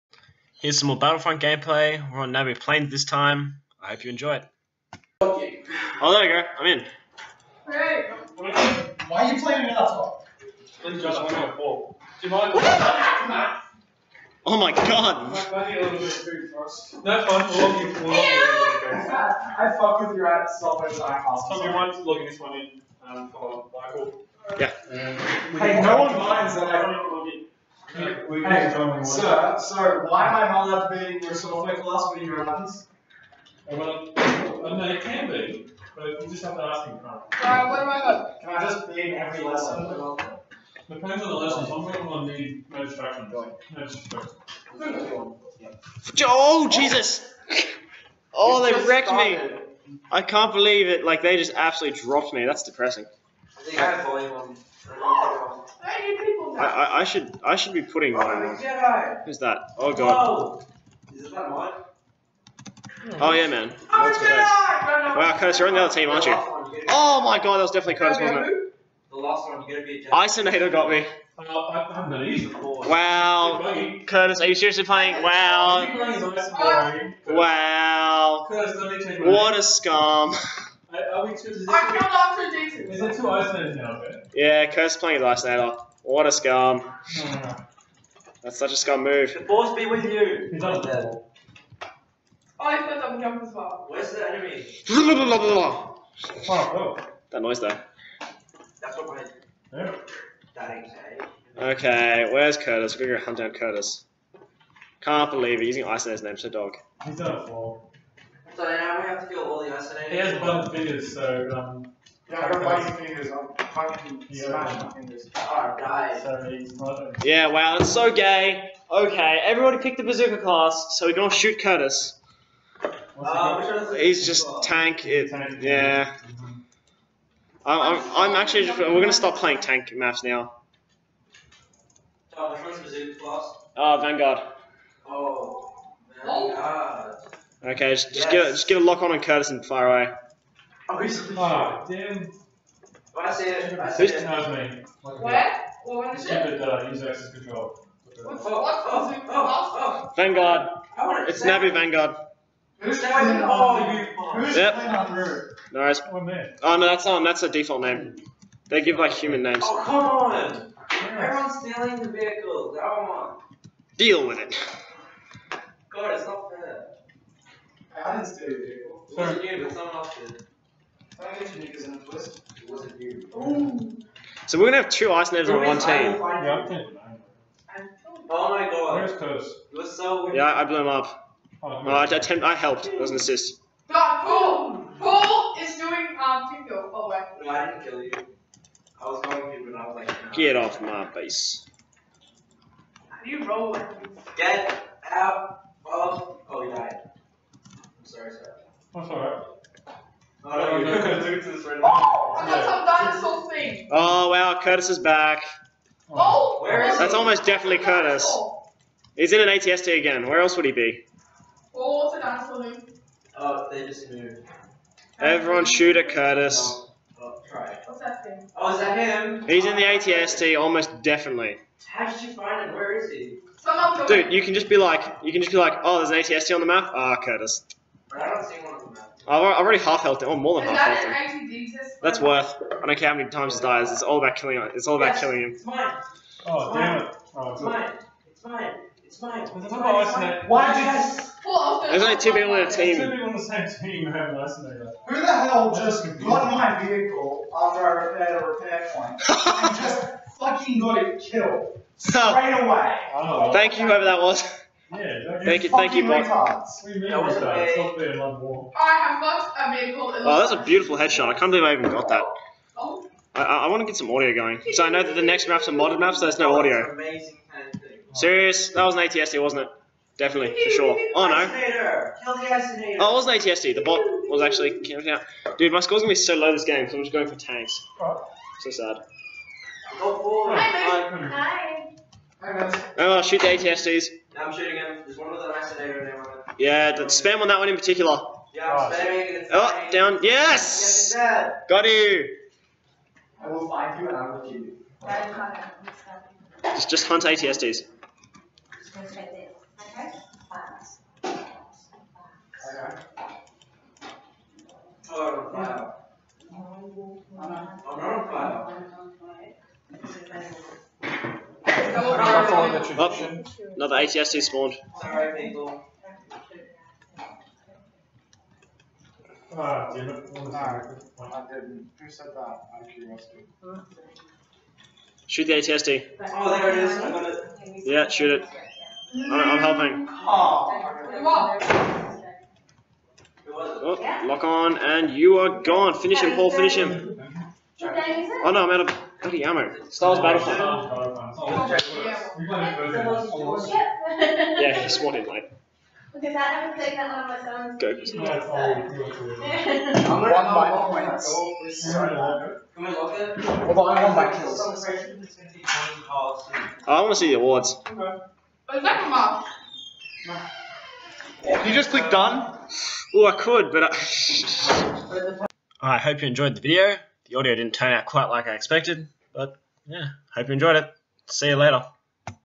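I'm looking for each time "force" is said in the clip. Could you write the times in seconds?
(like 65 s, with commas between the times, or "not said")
89 s.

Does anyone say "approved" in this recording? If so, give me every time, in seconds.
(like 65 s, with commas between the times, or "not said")
not said.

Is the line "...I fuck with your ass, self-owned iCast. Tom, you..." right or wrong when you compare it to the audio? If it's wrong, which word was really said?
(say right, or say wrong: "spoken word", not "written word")
right.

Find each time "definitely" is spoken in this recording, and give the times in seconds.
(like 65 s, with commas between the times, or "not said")
67 s, 207 s, 221 s, 270 s.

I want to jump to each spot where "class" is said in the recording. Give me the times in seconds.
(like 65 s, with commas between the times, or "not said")
31 s, 120 s, 133 s.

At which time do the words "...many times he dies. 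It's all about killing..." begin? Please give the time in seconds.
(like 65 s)
233 s.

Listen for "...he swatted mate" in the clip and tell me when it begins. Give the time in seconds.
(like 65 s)
344 s.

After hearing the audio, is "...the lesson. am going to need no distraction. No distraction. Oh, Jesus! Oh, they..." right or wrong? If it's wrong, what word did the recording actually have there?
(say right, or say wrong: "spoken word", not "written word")
right.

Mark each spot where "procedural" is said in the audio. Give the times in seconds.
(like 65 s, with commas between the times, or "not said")
not said.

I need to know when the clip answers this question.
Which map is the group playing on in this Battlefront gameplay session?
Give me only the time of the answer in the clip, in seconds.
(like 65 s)
2 s.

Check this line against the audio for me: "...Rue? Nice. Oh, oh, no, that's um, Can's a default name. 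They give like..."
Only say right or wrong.
wrong.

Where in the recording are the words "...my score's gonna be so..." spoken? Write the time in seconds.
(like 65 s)
275 s.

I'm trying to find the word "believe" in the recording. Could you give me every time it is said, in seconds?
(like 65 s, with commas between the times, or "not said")
50 s, 105 s, 261 s.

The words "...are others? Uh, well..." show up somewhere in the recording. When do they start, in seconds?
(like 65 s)
32 s.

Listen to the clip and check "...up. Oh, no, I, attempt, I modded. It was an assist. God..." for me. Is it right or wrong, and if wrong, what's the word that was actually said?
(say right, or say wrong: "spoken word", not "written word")
wrong: "helped", not "modded".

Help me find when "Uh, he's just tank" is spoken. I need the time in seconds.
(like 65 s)
123 s.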